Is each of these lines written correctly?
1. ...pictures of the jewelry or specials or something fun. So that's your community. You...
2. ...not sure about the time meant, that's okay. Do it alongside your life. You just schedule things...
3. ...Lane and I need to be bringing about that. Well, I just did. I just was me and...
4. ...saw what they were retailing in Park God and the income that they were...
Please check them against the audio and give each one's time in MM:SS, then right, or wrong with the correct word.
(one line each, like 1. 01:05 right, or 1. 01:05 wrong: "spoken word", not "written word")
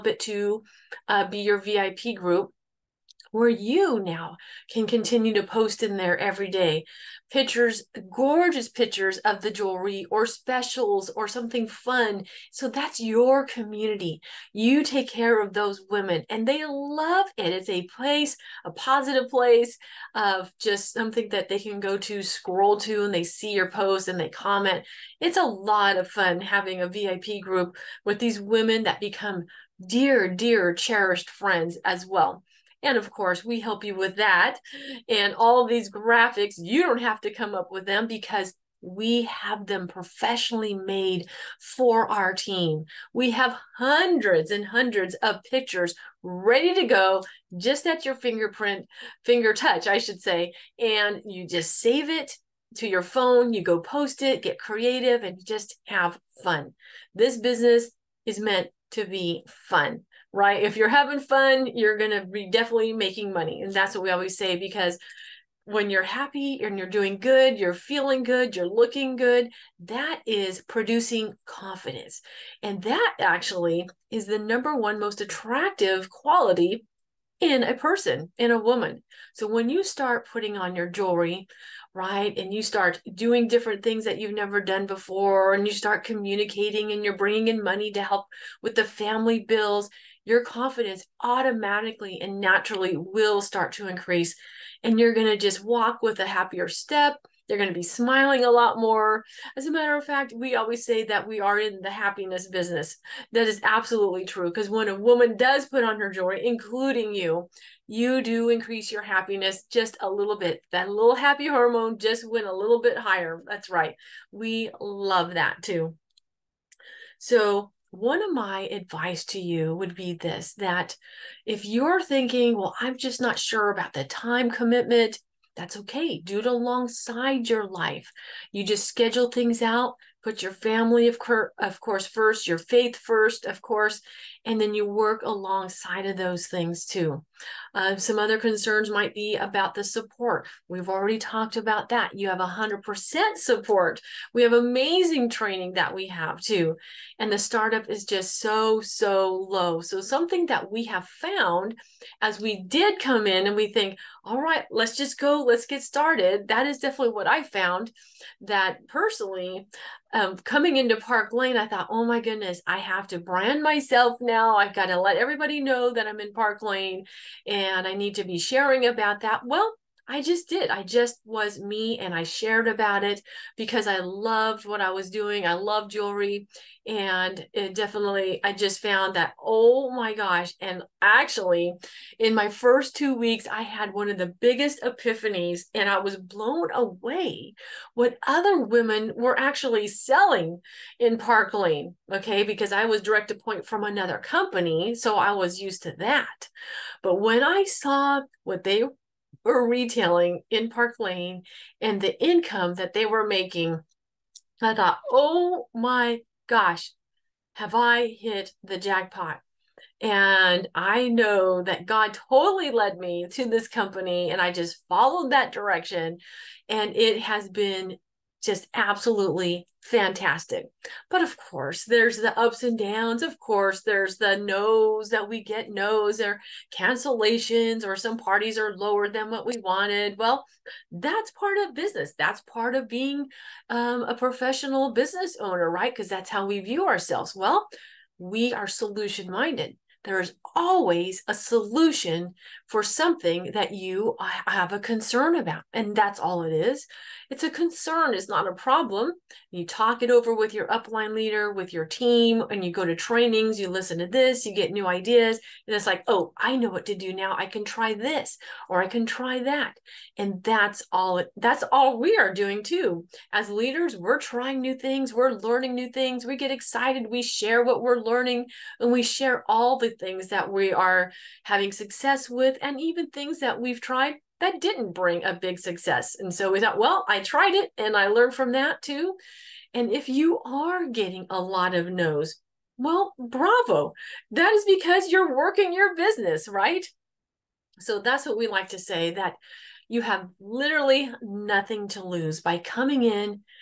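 1. 00:08 right
2. 02:03 wrong: "commitment", not "meant"
3. 02:46 wrong: "sharing", not "bringing"
4. 03:17 wrong: "Lane", not "God".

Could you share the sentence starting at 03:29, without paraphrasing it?
And I know that God totally led me to this company and I just followed that direction.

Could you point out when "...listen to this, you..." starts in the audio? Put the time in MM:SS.
04:13.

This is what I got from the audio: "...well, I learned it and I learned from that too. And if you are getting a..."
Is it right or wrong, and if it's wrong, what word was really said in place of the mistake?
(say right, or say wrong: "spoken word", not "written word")
wrong: "tried", not "learned".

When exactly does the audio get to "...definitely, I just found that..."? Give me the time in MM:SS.
02:57.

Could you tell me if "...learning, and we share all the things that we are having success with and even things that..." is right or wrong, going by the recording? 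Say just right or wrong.
right.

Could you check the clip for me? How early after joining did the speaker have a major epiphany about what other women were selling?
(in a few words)
First two weeks.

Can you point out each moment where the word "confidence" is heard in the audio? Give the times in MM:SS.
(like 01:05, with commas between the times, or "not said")
01:11, 01:30.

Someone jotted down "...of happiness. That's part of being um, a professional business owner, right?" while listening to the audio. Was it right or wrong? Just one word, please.
wrong.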